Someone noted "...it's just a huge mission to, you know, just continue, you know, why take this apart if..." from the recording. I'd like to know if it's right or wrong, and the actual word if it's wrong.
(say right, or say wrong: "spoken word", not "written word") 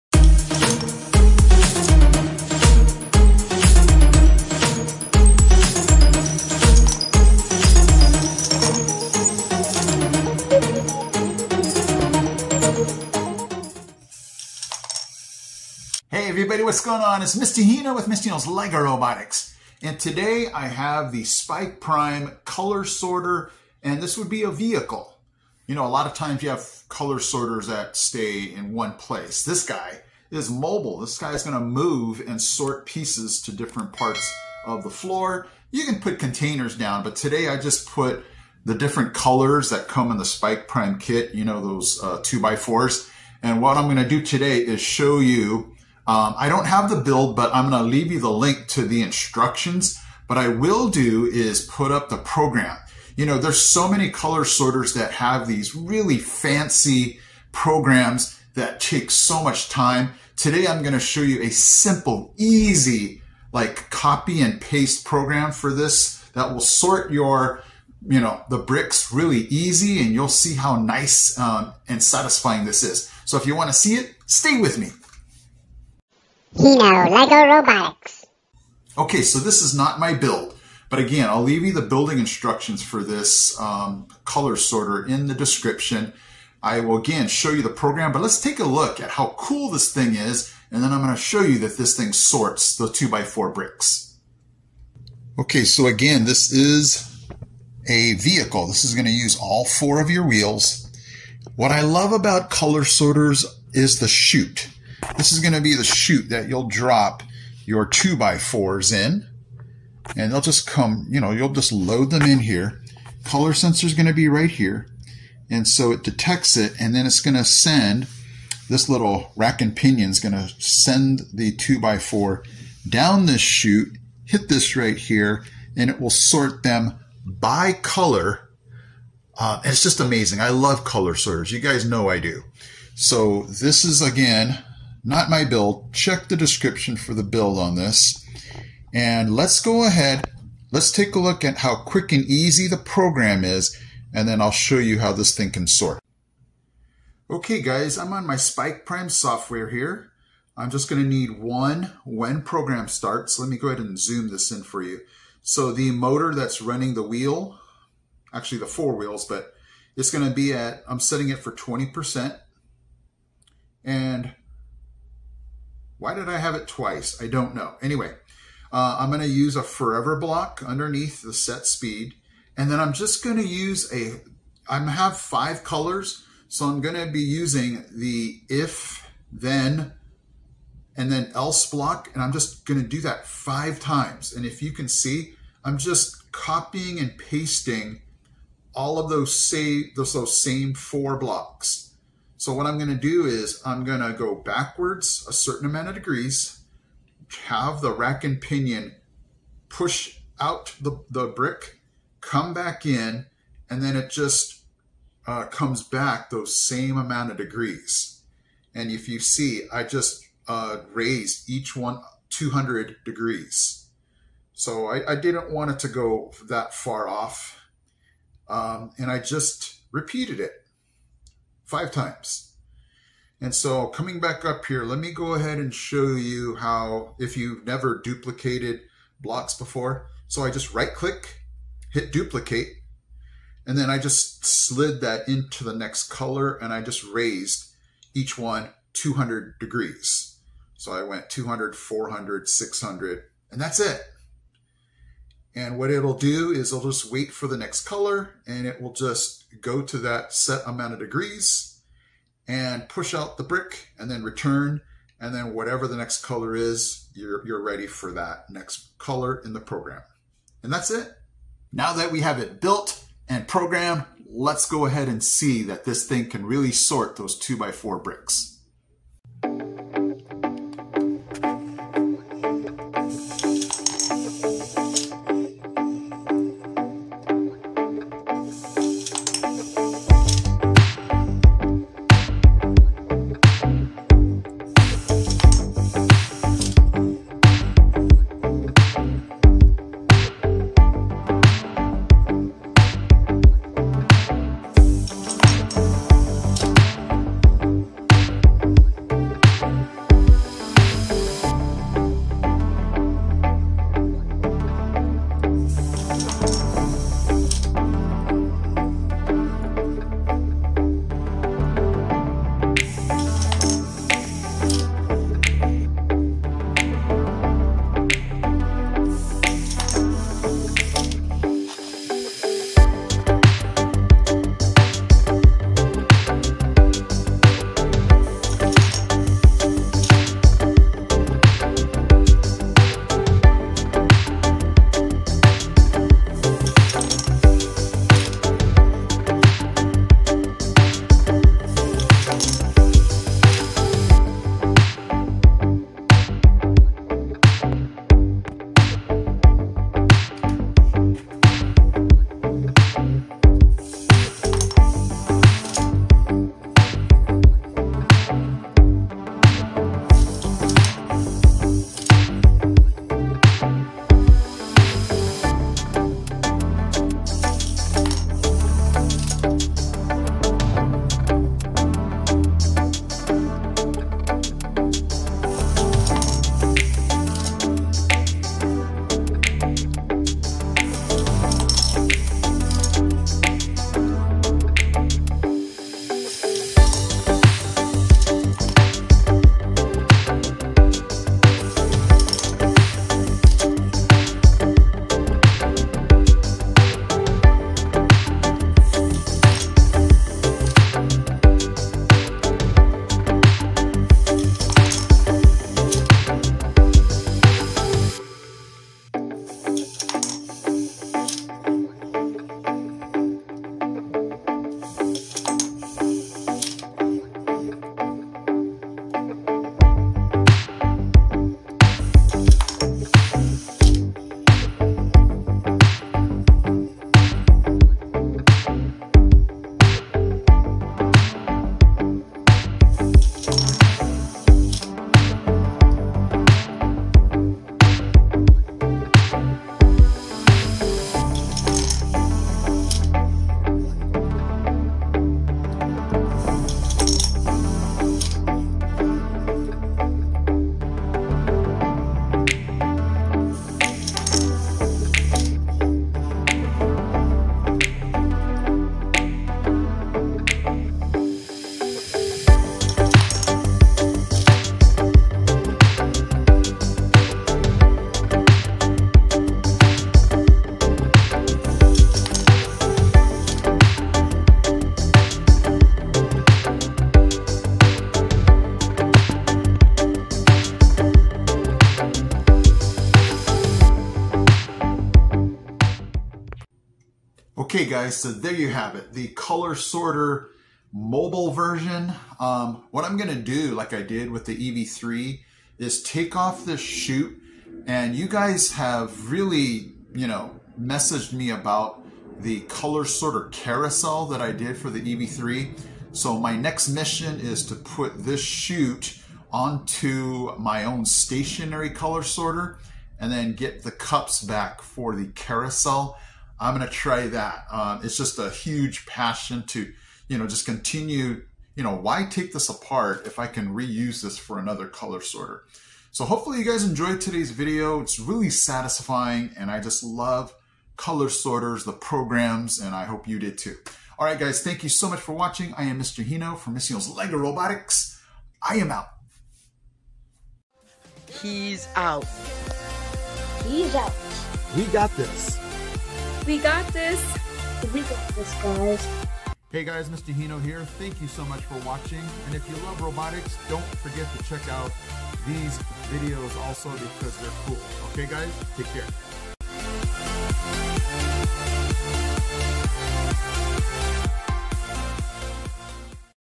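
wrong: "passion", not "mission".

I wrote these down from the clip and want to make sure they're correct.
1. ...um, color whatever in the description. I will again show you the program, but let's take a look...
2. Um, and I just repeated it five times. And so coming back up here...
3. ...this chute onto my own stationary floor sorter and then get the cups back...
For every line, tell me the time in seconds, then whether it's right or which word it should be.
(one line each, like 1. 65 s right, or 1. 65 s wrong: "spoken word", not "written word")
1. 83 s wrong: "sorter", not "whatever"
2. 218 s right
3. 508 s wrong: "color", not "floor".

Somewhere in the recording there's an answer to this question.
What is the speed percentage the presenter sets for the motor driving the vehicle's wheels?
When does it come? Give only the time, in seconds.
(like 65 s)
161 s.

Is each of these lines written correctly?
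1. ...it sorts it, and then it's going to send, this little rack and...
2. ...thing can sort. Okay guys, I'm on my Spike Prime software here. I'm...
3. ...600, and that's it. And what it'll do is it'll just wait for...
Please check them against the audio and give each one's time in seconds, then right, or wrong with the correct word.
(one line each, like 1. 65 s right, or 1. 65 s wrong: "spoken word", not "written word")
1. 115 s wrong: "detects", not "sorts"
2. 145 s right
3. 242 s right.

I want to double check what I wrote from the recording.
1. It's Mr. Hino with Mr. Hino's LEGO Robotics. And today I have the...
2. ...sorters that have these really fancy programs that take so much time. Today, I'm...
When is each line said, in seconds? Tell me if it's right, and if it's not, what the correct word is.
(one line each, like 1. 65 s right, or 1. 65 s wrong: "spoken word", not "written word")
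1. 17 s right
2. 54 s right.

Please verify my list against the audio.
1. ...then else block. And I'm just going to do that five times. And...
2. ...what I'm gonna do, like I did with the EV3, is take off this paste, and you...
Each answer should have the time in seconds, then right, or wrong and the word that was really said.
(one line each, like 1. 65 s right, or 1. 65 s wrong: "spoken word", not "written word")
1. 181 s right
2. 492 s wrong: "chute", not "paste".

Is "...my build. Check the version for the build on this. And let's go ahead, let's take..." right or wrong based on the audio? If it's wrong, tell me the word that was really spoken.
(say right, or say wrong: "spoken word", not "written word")
wrong: "description", not "version".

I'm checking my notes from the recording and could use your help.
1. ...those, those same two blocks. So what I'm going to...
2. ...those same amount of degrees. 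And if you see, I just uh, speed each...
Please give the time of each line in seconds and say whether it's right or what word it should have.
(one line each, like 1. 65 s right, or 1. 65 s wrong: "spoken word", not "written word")
1. 189 s wrong: "four", not "two"
2. 206 s wrong: "raised", not "speed".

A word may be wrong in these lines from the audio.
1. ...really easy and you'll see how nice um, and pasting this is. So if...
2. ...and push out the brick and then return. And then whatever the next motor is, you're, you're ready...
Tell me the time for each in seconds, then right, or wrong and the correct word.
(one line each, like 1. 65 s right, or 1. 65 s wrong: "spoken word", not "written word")
1. 69 s wrong: "satisfying", not "pasting"
2. 252 s wrong: "color", not "motor".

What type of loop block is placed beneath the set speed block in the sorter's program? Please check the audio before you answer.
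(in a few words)
Forever block.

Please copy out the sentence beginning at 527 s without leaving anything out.
It's really satisfying and I just love color sorters, the programs, and I hope you did too.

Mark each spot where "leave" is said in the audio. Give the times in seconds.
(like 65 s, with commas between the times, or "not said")
47 s, 81 s.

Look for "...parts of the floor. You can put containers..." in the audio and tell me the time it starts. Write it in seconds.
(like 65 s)
33 s.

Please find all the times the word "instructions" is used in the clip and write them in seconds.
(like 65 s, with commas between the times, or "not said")
49 s, 82 s.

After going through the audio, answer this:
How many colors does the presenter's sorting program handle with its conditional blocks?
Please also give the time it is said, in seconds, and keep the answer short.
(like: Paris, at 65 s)
5, at 175 s.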